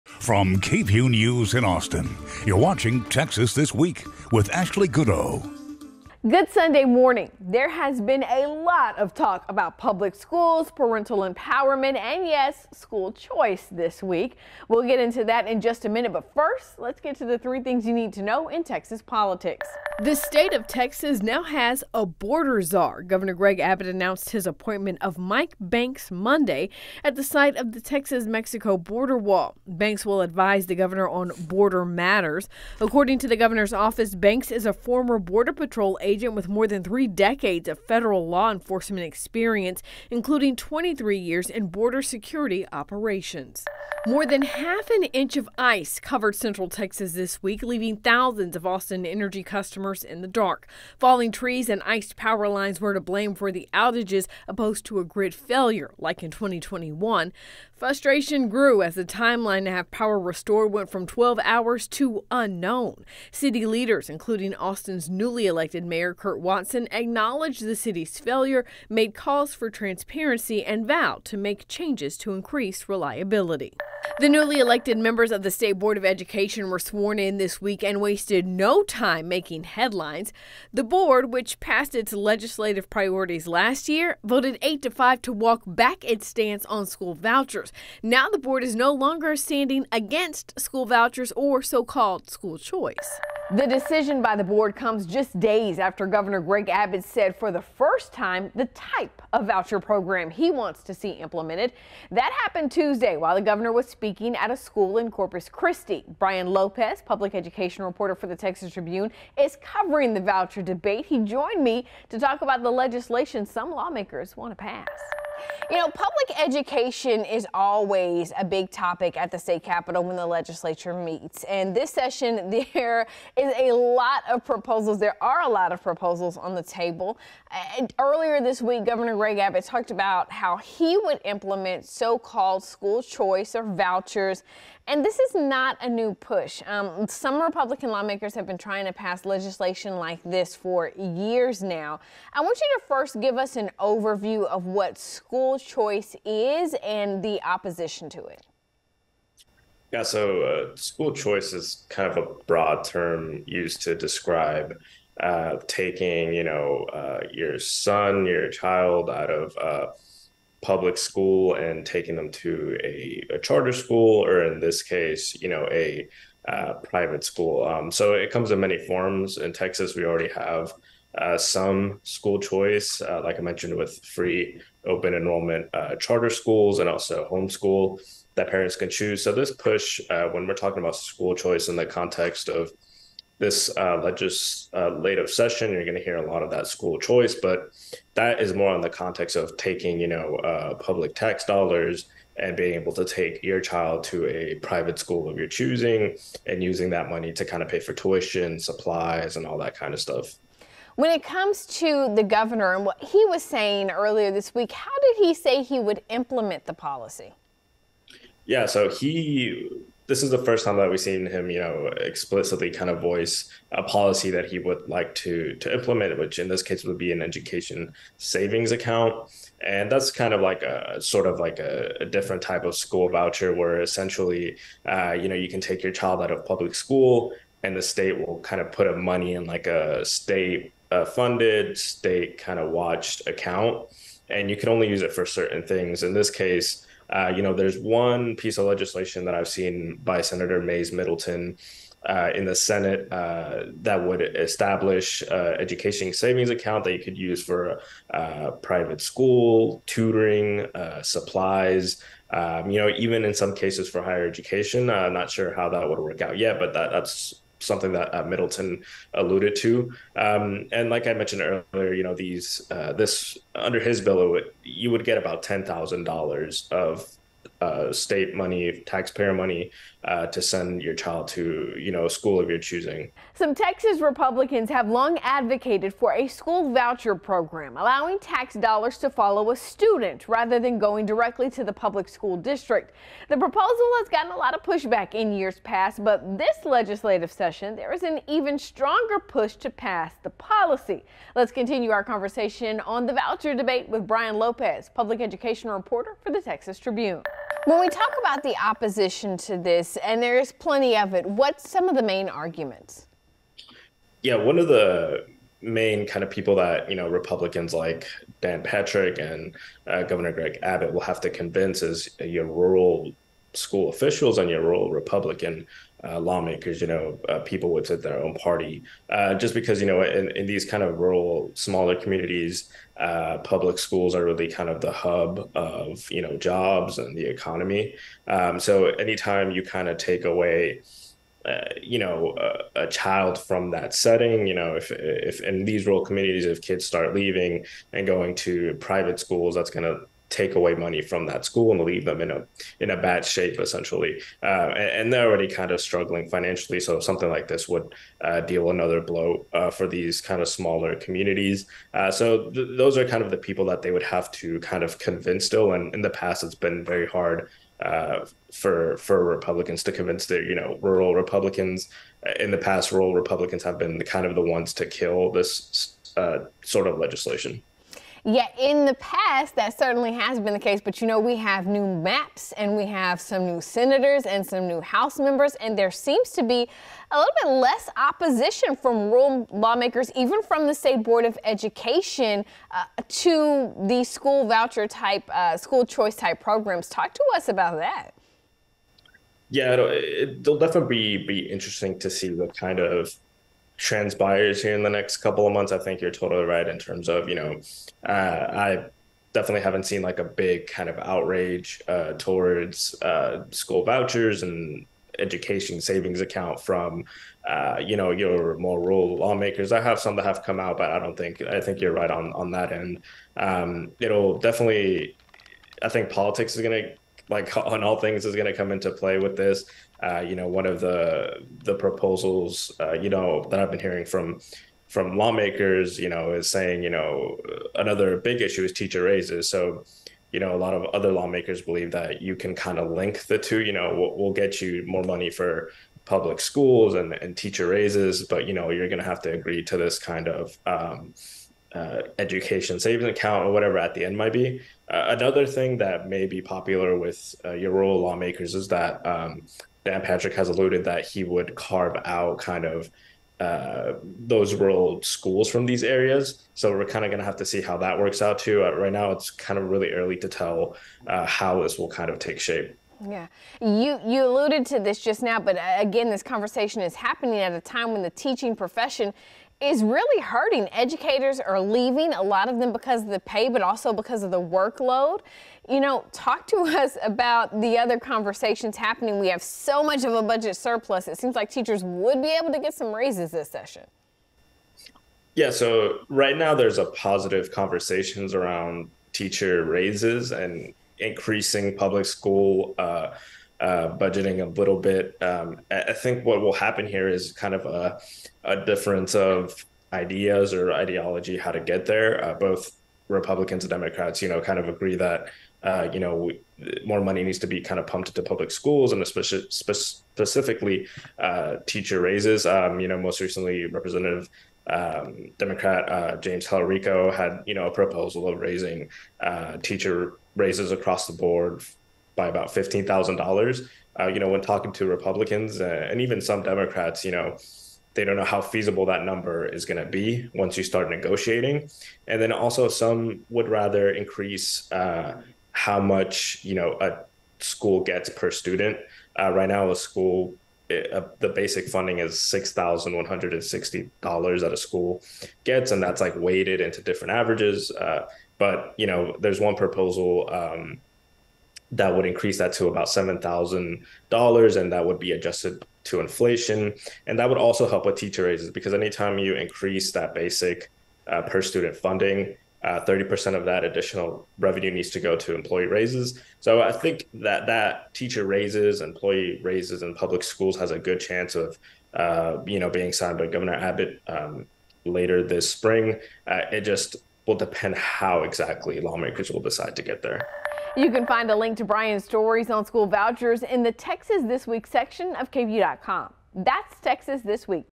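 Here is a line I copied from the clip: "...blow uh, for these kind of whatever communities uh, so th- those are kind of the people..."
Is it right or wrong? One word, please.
wrong.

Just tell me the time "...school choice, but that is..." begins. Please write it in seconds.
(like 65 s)
186 s.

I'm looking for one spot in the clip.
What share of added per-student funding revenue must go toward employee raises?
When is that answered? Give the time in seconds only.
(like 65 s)
562 s.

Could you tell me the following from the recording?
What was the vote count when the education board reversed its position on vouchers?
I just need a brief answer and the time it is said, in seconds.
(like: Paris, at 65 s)
8 to 5, at 84 s.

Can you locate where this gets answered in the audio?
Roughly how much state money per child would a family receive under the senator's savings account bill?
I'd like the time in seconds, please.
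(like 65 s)
265 s.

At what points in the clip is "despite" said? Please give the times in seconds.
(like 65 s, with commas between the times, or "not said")
not said.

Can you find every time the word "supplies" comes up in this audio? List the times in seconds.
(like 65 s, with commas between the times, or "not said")
198 s, 251 s.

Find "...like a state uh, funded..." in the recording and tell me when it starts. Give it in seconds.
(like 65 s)
229 s.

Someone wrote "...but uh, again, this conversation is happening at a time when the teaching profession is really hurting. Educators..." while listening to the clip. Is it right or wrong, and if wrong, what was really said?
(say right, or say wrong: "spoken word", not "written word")
right.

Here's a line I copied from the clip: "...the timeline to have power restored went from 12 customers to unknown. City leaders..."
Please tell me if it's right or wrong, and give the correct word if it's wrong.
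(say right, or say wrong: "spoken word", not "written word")
wrong: "hours", not "customers".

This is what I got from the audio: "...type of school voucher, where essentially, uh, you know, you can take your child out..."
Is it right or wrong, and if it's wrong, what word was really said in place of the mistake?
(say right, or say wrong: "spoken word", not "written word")
right.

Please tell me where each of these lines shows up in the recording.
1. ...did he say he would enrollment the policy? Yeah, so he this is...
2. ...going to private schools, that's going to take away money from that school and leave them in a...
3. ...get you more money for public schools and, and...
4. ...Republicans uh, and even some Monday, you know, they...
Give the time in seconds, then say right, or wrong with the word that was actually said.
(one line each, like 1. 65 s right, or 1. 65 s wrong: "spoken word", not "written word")
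1. 205 s wrong: "implement", not "enrollment"
2. 338 s right
3. 434 s right
4. 524 s wrong: "Democrats", not "Monday".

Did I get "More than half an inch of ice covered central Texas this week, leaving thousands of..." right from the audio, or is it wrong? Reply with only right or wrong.
right.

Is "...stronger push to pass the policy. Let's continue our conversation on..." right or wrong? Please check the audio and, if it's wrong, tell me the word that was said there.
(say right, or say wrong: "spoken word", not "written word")
right.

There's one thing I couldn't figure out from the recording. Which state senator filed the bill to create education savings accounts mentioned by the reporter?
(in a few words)
Mayes Middleton.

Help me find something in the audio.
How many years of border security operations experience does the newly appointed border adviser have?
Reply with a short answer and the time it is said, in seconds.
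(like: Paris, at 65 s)
23 years, at 40 s.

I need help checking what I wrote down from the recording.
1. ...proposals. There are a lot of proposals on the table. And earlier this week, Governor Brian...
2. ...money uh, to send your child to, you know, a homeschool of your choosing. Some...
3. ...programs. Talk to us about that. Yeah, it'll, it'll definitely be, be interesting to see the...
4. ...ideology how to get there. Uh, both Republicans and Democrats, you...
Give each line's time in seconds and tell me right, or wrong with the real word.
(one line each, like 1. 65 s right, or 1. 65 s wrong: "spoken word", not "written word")
1. 124 s wrong: "Greg", not "Brian"
2. 269 s wrong: "school", not "homeschool"
3. 386 s right
4. 500 s right.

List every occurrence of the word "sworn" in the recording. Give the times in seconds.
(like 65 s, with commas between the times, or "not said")
76 s.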